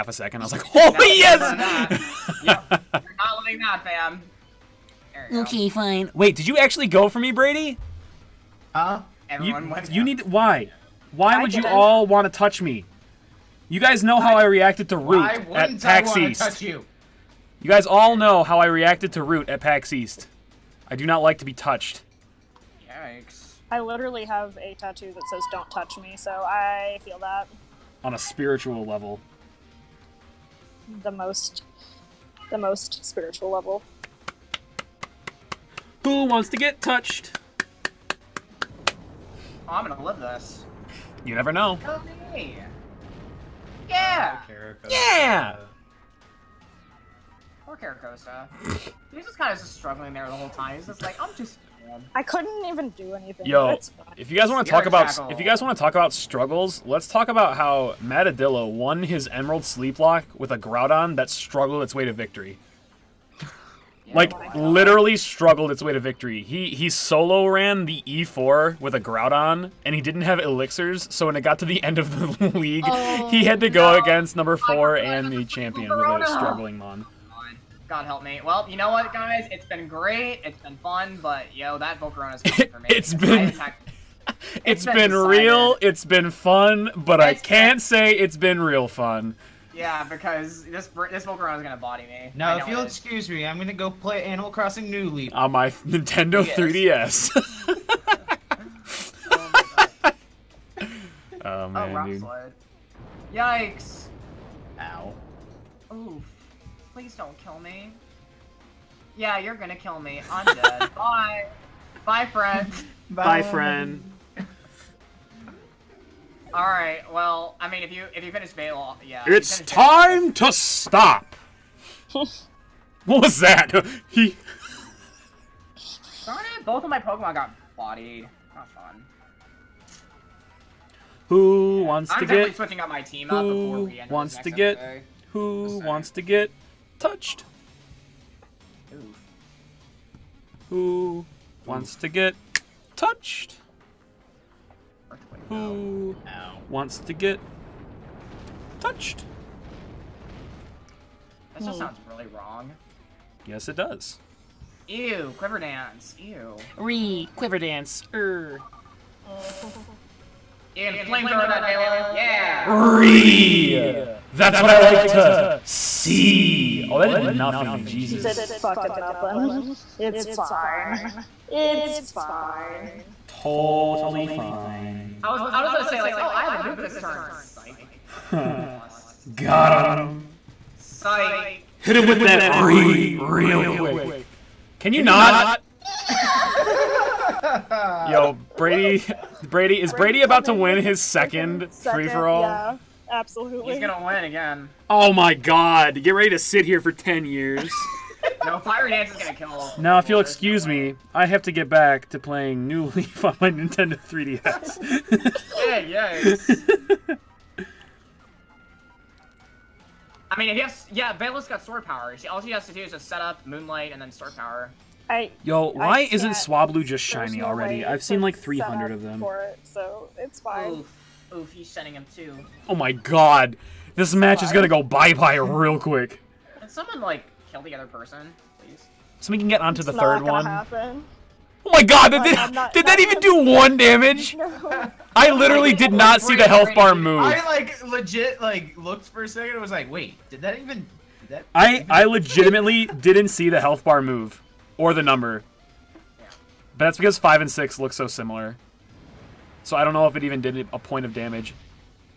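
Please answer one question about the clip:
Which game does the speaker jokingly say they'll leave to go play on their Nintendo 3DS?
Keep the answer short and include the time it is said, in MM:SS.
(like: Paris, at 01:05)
Animal Crossing New Leaf, at 01:34.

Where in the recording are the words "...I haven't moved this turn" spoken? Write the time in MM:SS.
02:56.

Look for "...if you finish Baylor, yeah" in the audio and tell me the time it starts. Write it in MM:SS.
01:58.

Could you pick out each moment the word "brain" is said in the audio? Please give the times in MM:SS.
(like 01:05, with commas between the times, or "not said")
not said.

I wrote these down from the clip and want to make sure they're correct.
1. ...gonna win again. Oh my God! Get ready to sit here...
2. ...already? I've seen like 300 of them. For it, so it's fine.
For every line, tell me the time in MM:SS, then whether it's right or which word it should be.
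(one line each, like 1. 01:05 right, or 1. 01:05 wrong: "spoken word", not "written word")
1. 03:13 right
2. 03:37 right.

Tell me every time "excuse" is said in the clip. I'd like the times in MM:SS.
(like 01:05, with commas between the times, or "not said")
01:32, 03:20.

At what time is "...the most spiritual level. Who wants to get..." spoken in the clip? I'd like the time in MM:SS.
00:32.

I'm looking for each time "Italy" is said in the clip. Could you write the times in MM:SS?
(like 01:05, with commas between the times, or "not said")
not said.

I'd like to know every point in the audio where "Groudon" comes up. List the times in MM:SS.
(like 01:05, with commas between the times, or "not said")
01:00, 01:08.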